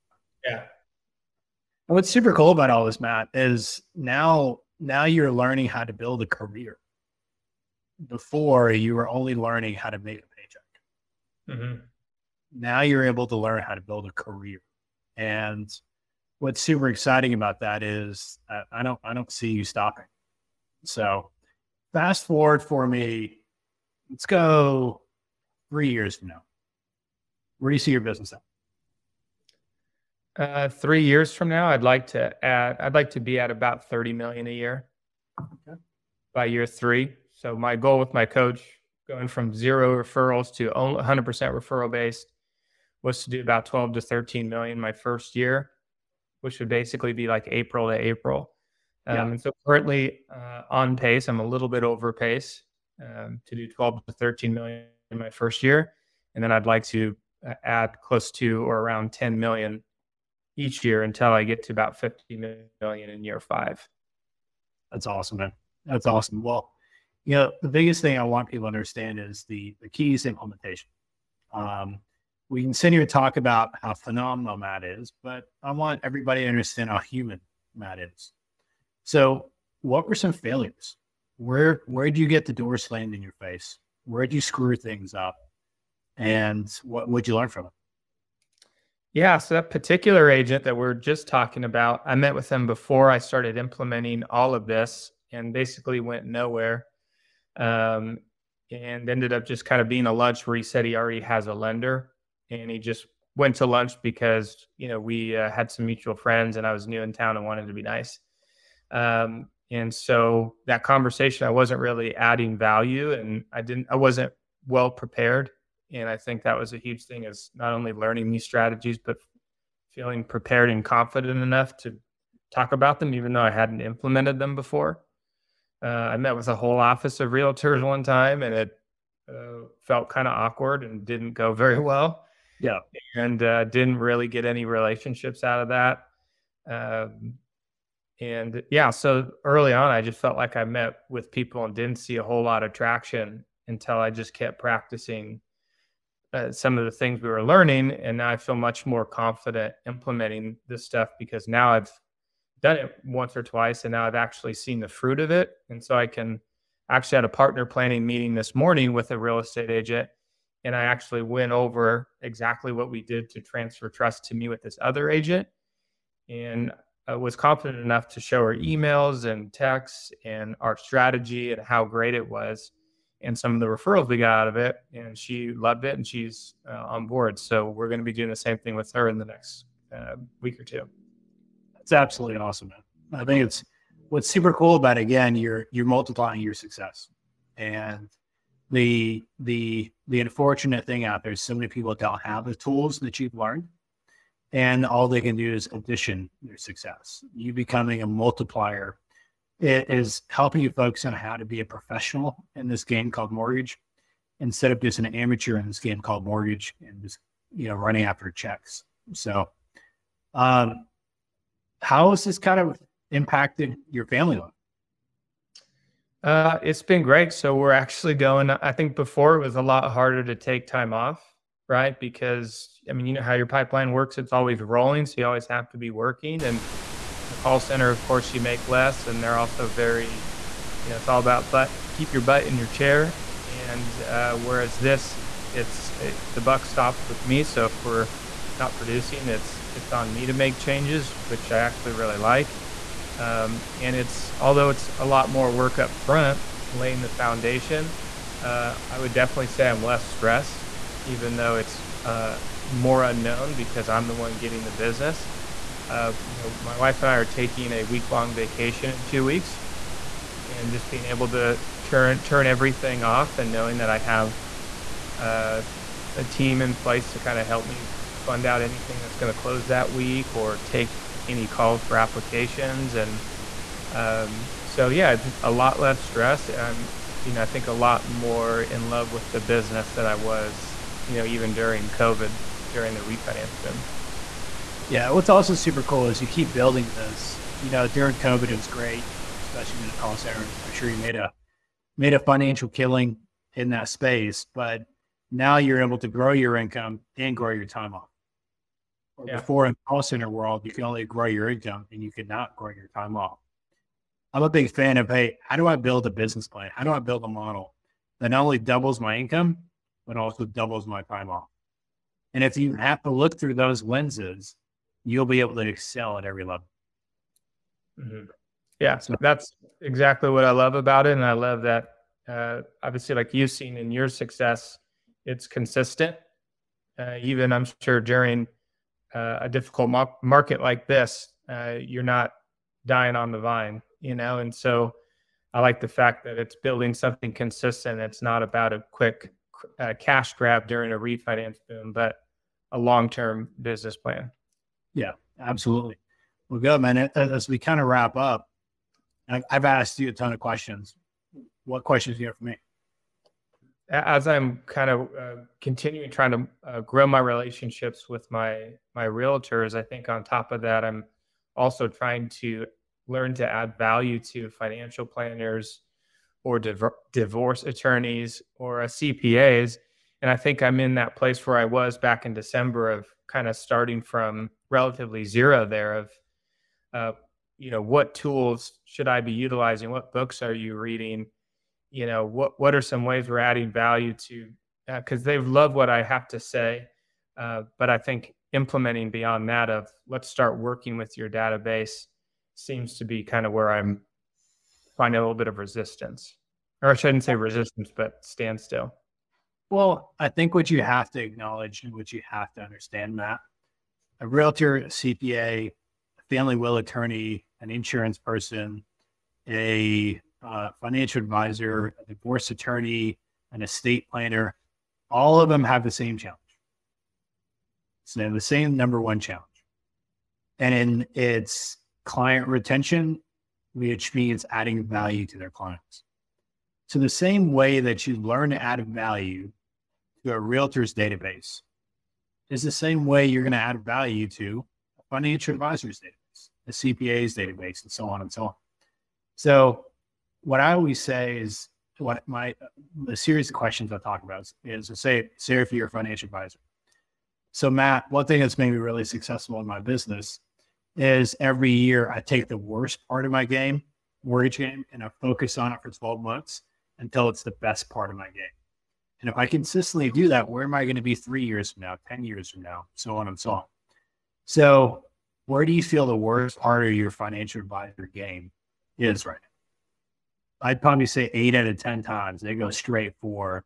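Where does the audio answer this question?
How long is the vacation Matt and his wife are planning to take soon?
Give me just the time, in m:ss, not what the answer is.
4:17.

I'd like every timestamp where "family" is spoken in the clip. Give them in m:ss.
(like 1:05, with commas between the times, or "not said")
3:34, 6:46.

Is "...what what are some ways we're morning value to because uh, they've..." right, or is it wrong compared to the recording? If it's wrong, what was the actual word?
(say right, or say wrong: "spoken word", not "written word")
wrong: "adding", not "morning".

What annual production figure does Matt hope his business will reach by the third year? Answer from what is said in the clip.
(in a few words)
30 million.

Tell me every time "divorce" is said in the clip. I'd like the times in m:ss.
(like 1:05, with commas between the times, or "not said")
6:07, 6:52.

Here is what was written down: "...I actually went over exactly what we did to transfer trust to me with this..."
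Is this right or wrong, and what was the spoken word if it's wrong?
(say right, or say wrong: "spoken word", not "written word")
right.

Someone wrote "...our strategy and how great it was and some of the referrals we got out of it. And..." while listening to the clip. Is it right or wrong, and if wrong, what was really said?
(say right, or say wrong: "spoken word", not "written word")
right.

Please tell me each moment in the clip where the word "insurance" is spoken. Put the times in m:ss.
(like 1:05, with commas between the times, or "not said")
6:47.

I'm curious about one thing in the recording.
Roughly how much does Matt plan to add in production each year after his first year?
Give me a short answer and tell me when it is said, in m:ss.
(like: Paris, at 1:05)
10 million, at 0:59.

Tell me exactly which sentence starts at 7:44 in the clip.
So where do you feel the worst part of your financial advisor game is right now?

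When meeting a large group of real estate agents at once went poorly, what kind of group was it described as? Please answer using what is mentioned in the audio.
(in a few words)
A whole office of realtors.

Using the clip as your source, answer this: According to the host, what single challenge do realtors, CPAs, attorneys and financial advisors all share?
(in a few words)
Client retention.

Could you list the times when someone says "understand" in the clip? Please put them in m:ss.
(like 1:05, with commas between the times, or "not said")
1:08, 1:16, 6:42.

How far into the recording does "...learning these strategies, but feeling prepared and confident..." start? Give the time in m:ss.
1:57.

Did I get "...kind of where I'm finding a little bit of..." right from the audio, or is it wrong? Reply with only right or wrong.
right.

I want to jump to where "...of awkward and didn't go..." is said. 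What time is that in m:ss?
2:10.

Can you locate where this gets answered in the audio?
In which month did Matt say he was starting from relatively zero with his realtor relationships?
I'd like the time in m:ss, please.
6:12.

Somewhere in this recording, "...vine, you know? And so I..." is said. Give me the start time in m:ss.
5:33.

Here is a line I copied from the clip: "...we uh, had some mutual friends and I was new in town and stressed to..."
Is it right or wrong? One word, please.
wrong.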